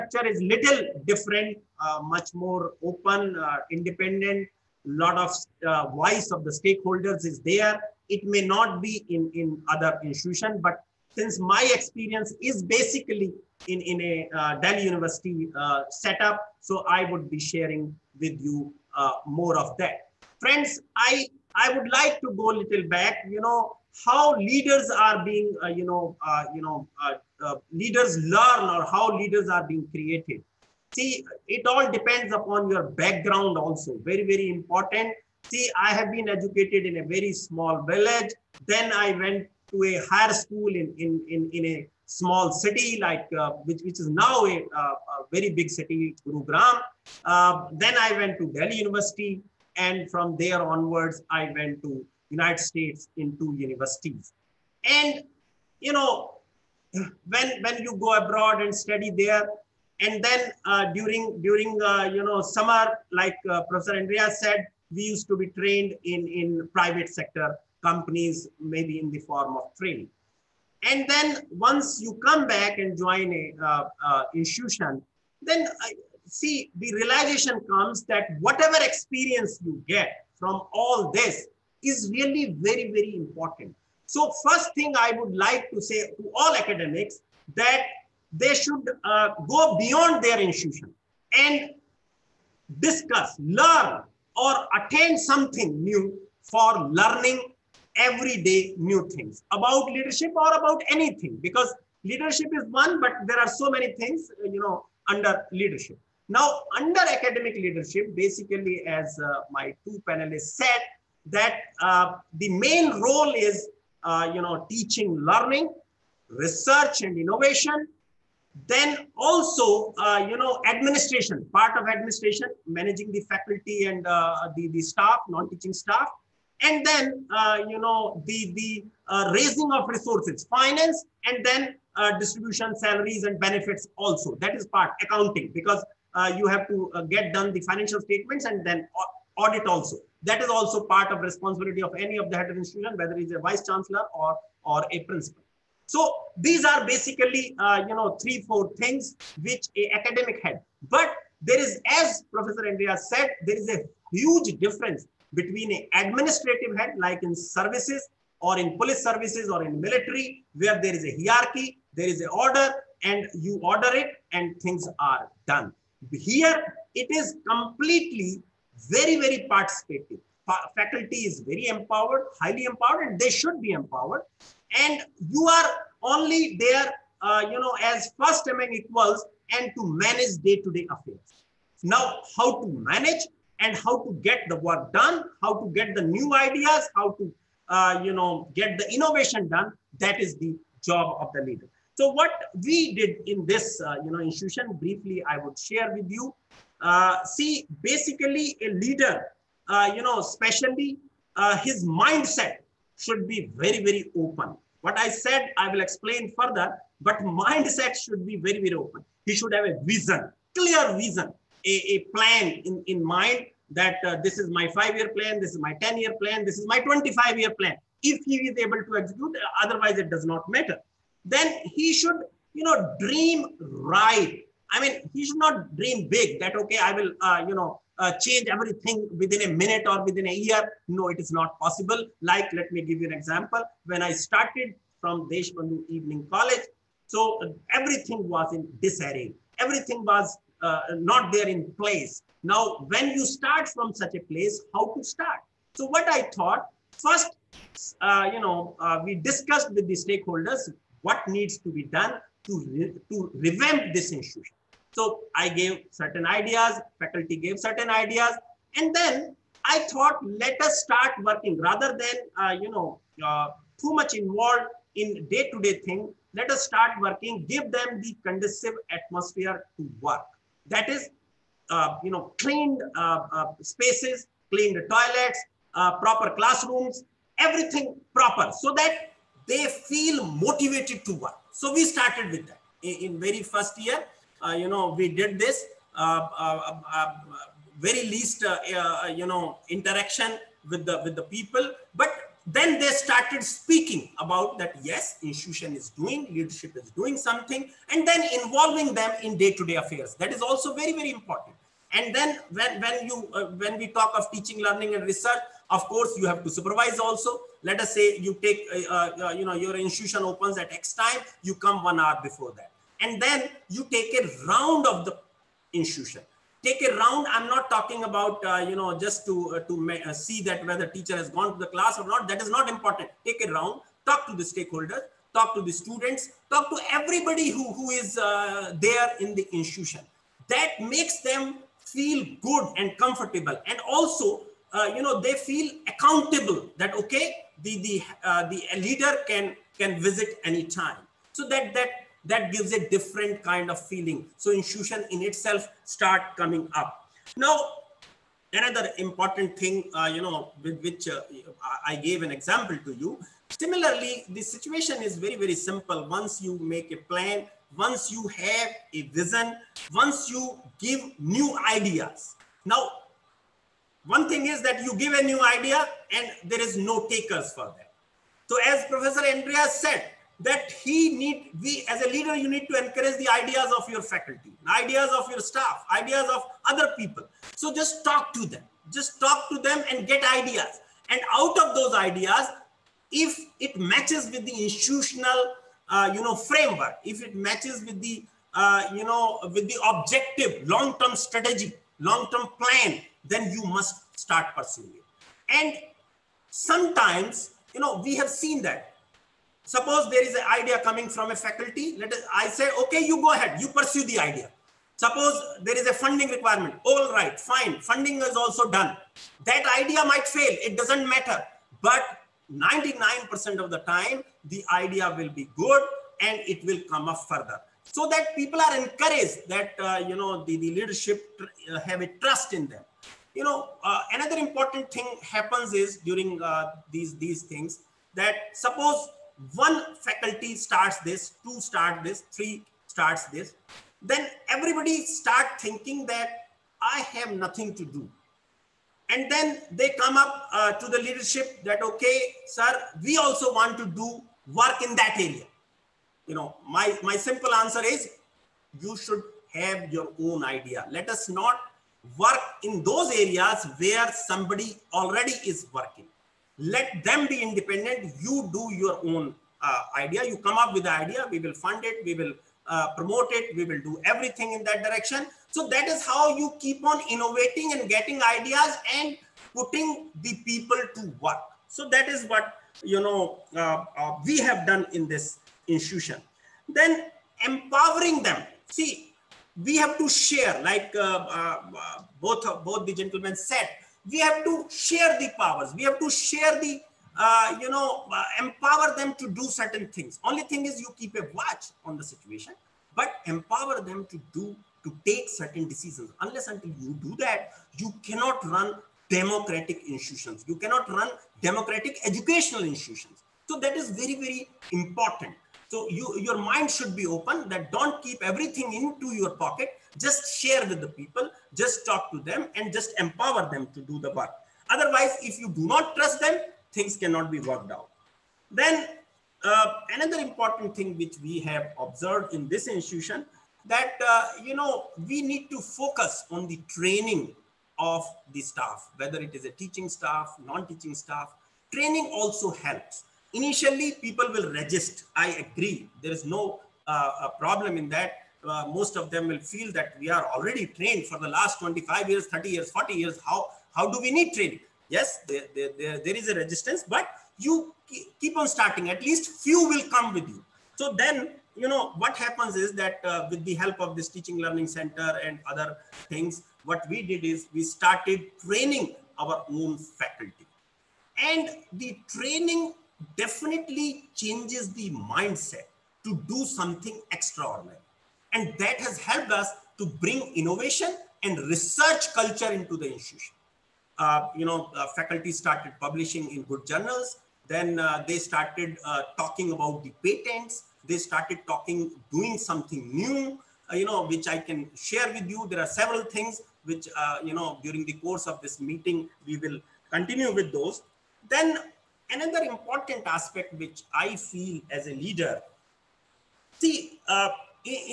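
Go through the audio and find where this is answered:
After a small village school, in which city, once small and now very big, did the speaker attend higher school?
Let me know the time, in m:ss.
0:46.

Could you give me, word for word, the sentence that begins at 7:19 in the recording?
And then they come up uh, to the leadership that, okay, sir, we also want to do work in that area.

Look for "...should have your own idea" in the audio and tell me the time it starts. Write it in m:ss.
7:28.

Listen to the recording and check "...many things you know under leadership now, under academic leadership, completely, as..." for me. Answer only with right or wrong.
wrong.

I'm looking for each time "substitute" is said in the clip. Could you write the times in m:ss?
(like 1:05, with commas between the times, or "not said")
not said.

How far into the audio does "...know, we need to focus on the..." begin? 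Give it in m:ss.
8:44.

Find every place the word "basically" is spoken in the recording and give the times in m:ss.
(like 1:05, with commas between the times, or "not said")
0:12, 1:48, 2:26, 3:17.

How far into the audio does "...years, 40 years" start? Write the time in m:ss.
9:02.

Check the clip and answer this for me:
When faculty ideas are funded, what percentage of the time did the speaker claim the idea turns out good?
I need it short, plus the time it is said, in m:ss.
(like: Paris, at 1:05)
99%, at 6:52.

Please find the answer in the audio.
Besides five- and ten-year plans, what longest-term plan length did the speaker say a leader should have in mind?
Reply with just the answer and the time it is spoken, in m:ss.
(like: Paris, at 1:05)
25 years, at 3:36.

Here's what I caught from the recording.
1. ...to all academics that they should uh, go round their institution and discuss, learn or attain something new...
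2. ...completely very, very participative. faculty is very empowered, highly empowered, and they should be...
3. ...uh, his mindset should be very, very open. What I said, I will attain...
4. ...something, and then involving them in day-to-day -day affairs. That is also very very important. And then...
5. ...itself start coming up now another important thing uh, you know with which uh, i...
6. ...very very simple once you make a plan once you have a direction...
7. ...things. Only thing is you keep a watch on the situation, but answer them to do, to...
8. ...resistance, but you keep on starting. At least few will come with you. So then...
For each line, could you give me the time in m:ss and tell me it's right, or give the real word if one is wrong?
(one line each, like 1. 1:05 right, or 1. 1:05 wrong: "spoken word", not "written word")
1. 1:26 wrong: "beyond", not "round"
2. 2:47 right
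3. 3:21 wrong: "explain", not "attain"
4. 4:57 right
5. 5:45 right
6. 5:55 wrong: "vision", not "direction"
7. 8:09 wrong: "empower", not "answer"
8. 9:06 right.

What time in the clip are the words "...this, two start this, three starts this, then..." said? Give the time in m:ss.
7:10.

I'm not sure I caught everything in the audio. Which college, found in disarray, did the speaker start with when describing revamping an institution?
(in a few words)
Deshbandhu Evening College.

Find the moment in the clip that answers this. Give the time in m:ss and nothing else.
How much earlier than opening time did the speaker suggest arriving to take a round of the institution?
5:11.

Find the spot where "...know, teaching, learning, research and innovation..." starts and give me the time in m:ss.
1:54.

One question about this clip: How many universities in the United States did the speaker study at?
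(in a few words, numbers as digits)
2.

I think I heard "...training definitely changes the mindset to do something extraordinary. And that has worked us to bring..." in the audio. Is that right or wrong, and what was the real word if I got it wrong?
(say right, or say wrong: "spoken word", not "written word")
wrong: "helped", not "worked".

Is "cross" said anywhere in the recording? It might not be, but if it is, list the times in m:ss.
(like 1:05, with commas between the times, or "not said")
not said.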